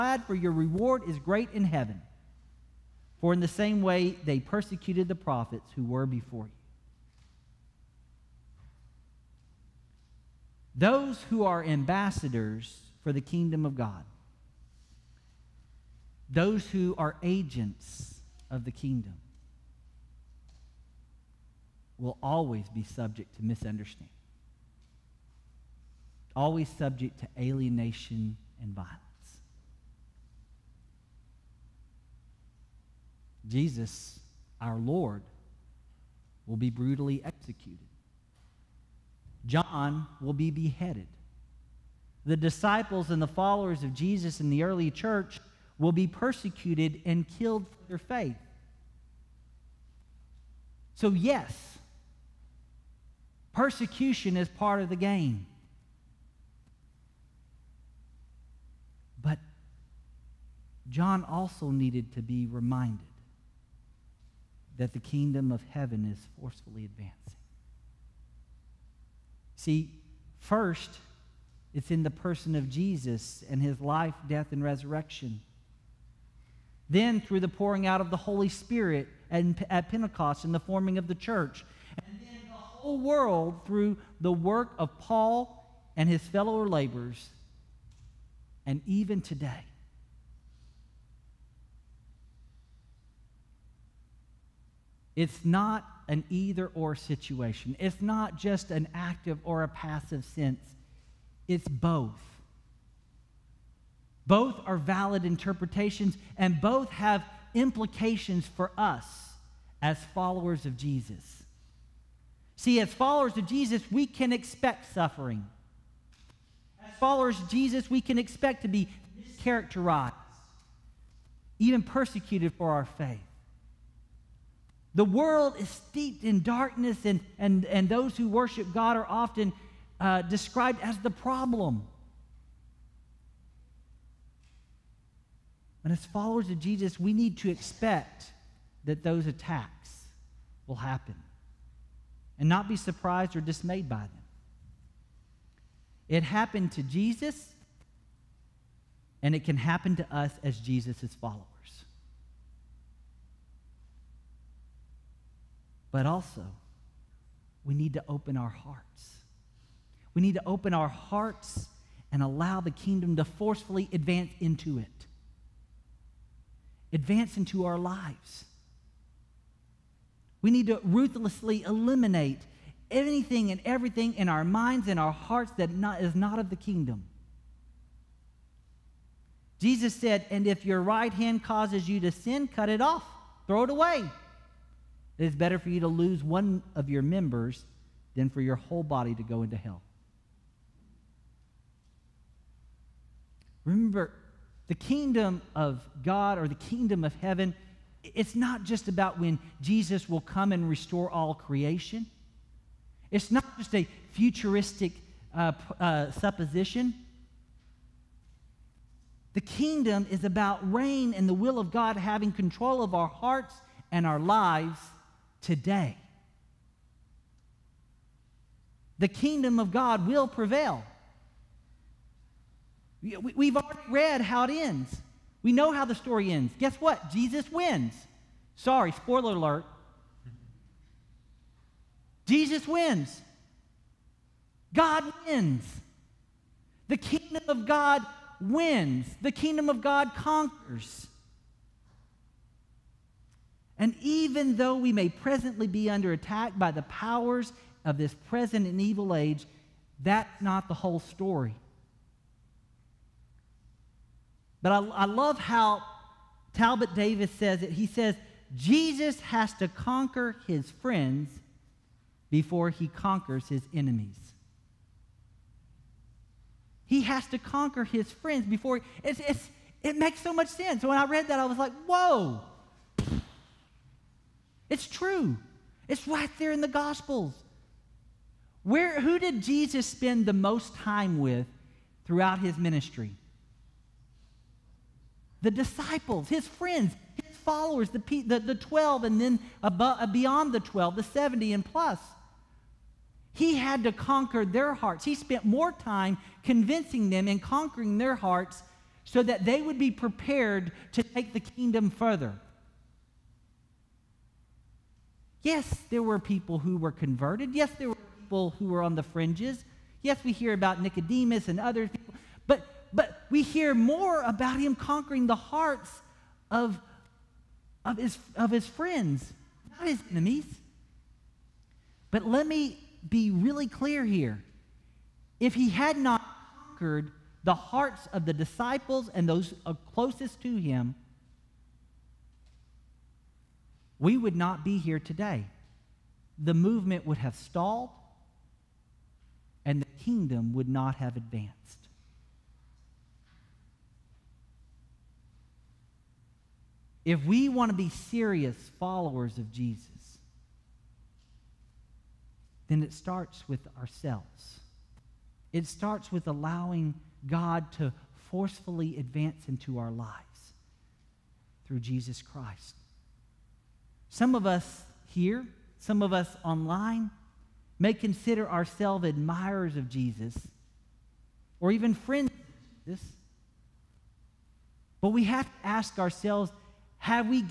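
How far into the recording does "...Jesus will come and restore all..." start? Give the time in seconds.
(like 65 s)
199 s.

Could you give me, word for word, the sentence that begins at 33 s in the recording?
Jesus, our Lord, will be brutally executed.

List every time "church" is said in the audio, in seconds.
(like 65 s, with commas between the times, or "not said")
44 s, 81 s.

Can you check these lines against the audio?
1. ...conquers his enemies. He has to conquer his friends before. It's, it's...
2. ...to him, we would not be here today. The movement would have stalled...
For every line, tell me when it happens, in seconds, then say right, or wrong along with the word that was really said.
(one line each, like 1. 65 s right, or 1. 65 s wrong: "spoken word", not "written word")
1. 262 s right
2. 330 s right.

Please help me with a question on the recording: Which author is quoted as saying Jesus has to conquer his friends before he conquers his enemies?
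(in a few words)
Talbot Davis.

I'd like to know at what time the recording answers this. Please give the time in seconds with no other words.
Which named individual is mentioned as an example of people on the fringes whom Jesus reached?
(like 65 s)
310 s.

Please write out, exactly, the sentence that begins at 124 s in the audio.
The world is steeped in darkness, and, and, and those who worship God are often uh, described as the problem.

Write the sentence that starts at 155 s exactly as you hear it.
But also, we need to open our hearts.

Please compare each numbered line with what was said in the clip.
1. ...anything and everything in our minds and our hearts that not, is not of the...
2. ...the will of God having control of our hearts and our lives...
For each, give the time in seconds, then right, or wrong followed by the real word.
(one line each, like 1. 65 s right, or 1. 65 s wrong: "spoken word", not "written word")
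1. 172 s right
2. 211 s right.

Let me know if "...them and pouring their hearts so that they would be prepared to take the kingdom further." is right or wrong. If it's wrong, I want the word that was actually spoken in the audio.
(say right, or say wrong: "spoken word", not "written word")
wrong: "conquering", not "pouring".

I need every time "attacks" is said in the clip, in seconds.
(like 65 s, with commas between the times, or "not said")
139 s, 246 s.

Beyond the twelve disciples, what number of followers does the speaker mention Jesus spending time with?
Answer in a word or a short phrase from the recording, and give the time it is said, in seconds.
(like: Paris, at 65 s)
70, at 290 s.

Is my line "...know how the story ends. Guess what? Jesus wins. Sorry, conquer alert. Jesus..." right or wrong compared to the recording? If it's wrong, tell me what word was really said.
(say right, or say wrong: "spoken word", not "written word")
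wrong: "spoiler", not "conquer".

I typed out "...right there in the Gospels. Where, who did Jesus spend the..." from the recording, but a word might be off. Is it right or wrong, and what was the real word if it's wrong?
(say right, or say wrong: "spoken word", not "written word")
right.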